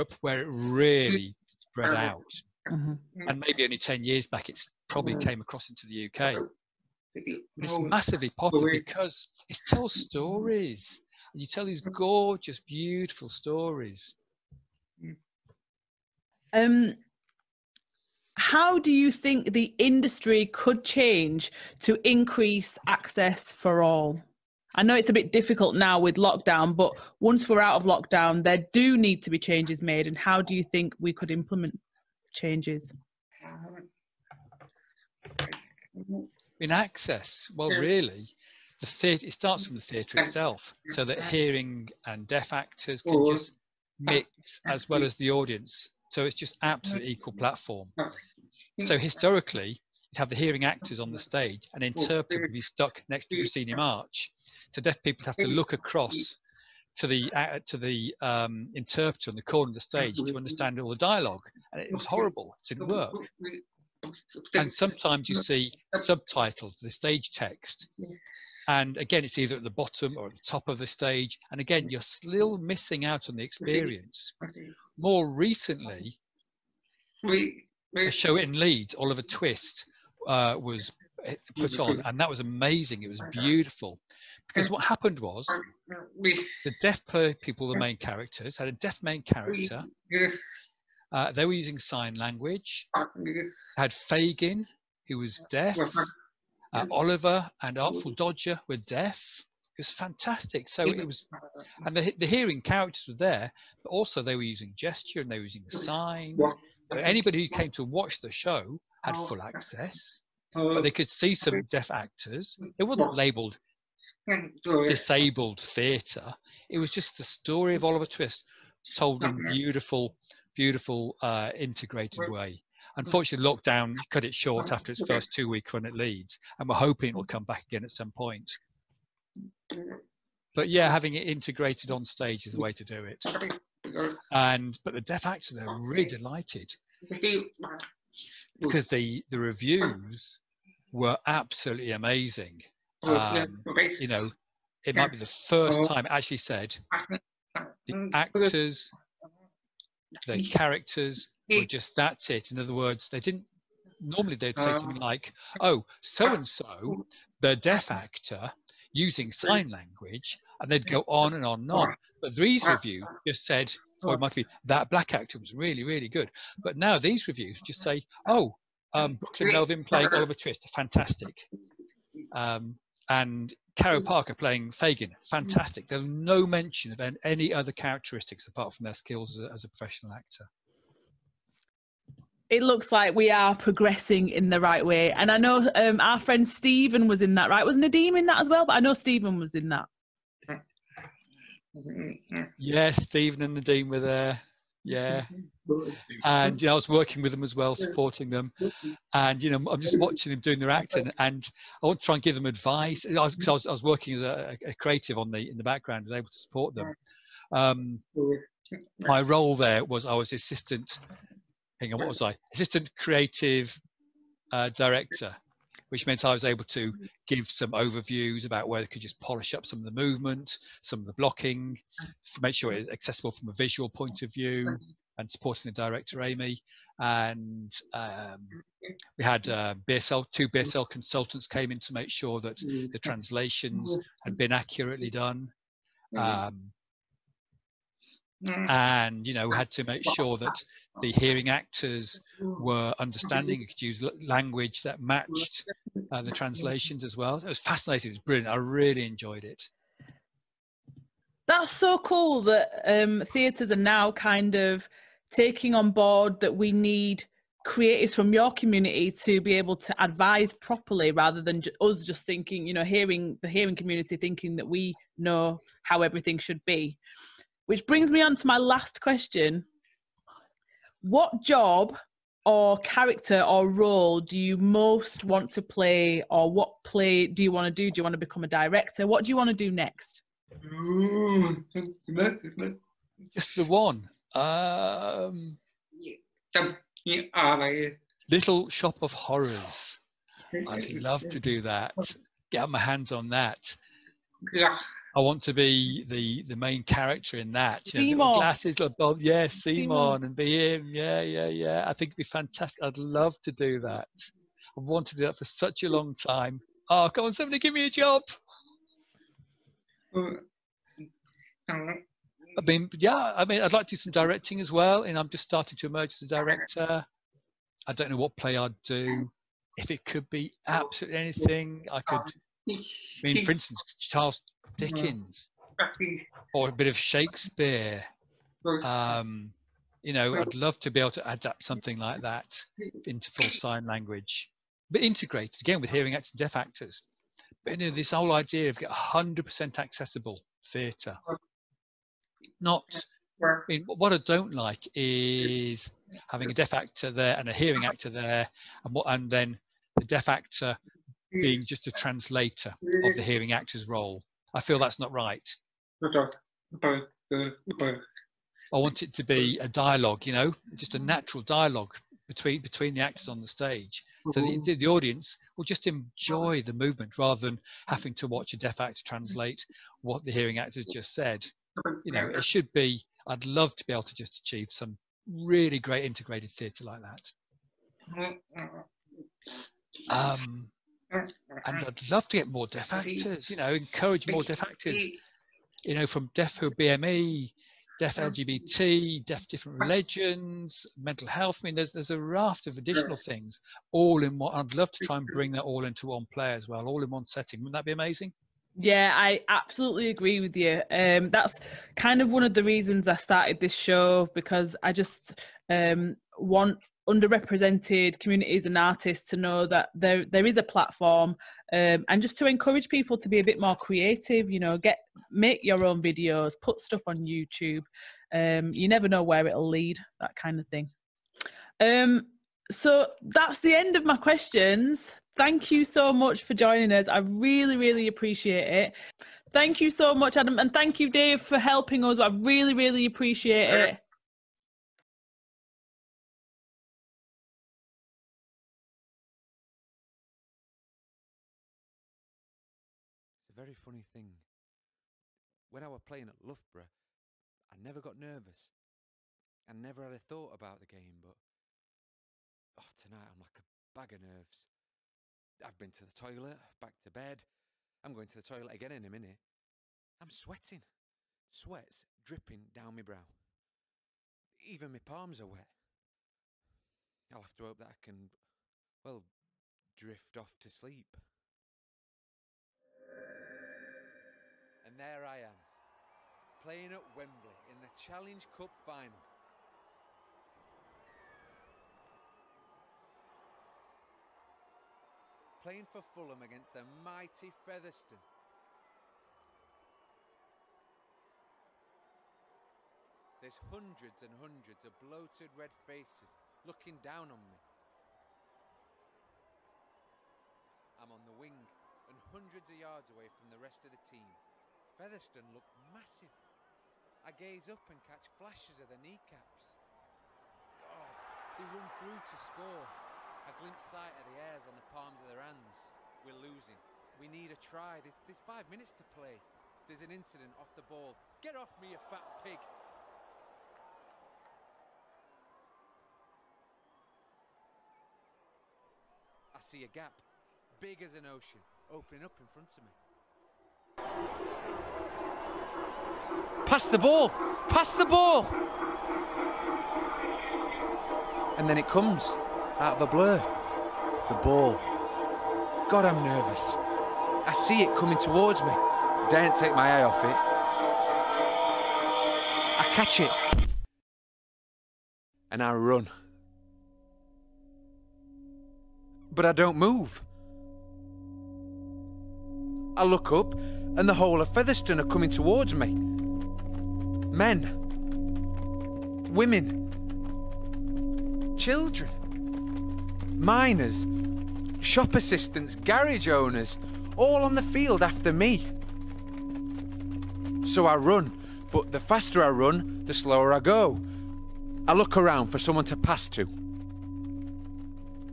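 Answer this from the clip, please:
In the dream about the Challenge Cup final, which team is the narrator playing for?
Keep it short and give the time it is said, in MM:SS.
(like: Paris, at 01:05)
Fulham, at 08:05.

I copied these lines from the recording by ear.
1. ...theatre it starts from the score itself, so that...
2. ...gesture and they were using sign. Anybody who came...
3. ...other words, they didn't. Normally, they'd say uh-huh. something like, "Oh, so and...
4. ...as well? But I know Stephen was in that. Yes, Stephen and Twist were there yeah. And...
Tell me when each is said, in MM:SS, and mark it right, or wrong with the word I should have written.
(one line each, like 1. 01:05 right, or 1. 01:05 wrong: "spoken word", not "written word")
1. 00:38 wrong: "theatre", not "score"
2. 01:44 right
3. 02:32 right
4. 03:08 wrong: "Nadim", not "Twist".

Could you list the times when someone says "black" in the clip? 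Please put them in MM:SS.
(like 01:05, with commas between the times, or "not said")
02:44.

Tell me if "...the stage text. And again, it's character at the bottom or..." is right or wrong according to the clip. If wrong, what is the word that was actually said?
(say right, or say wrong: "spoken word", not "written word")
wrong: "either", not "character".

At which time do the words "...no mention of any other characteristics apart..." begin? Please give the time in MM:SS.
02:56.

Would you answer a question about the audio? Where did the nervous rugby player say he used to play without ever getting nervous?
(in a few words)
Loughborough.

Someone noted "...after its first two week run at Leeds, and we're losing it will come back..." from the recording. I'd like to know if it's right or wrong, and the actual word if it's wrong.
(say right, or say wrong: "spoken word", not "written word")
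wrong: "hoping", not "losing".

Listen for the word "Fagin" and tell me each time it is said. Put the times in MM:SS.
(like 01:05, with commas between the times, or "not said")
01:34, 02:54.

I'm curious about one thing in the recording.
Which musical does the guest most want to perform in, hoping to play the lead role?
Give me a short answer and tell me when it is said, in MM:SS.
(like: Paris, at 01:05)
Little Shop of Horrors, at 04:48.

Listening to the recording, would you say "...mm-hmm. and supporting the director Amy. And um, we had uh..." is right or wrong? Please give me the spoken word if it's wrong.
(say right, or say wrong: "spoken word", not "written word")
right.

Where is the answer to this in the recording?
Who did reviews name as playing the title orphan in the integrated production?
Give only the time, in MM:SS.
02:49.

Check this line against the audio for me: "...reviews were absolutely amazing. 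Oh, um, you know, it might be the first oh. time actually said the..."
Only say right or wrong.
right.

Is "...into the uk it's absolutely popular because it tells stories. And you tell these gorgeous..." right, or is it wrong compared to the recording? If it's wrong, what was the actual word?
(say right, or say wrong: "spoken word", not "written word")
wrong: "massively", not "absolutely".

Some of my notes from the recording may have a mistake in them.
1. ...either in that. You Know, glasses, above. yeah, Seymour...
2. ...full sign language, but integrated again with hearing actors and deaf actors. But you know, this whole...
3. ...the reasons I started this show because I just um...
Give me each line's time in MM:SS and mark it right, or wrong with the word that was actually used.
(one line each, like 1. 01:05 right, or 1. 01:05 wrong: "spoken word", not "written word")
1. 04:56 wrong: "character", not "either"
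2. 05:33 right
3. 06:42 right.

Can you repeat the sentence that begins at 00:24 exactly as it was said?
I know it's a bit difficult now with lockdown, but once we're out of lockdown, there do need to be changes made.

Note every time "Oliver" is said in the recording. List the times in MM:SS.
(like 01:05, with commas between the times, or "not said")
01:18, 01:36, 01:57, 02:50.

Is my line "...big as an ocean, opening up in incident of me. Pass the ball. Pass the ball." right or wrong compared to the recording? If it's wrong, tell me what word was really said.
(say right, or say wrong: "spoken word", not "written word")
wrong: "front", not "incident".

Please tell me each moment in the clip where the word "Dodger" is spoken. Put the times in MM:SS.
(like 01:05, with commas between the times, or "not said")
01:38.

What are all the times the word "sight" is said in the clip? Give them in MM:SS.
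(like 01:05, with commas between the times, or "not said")
08:33.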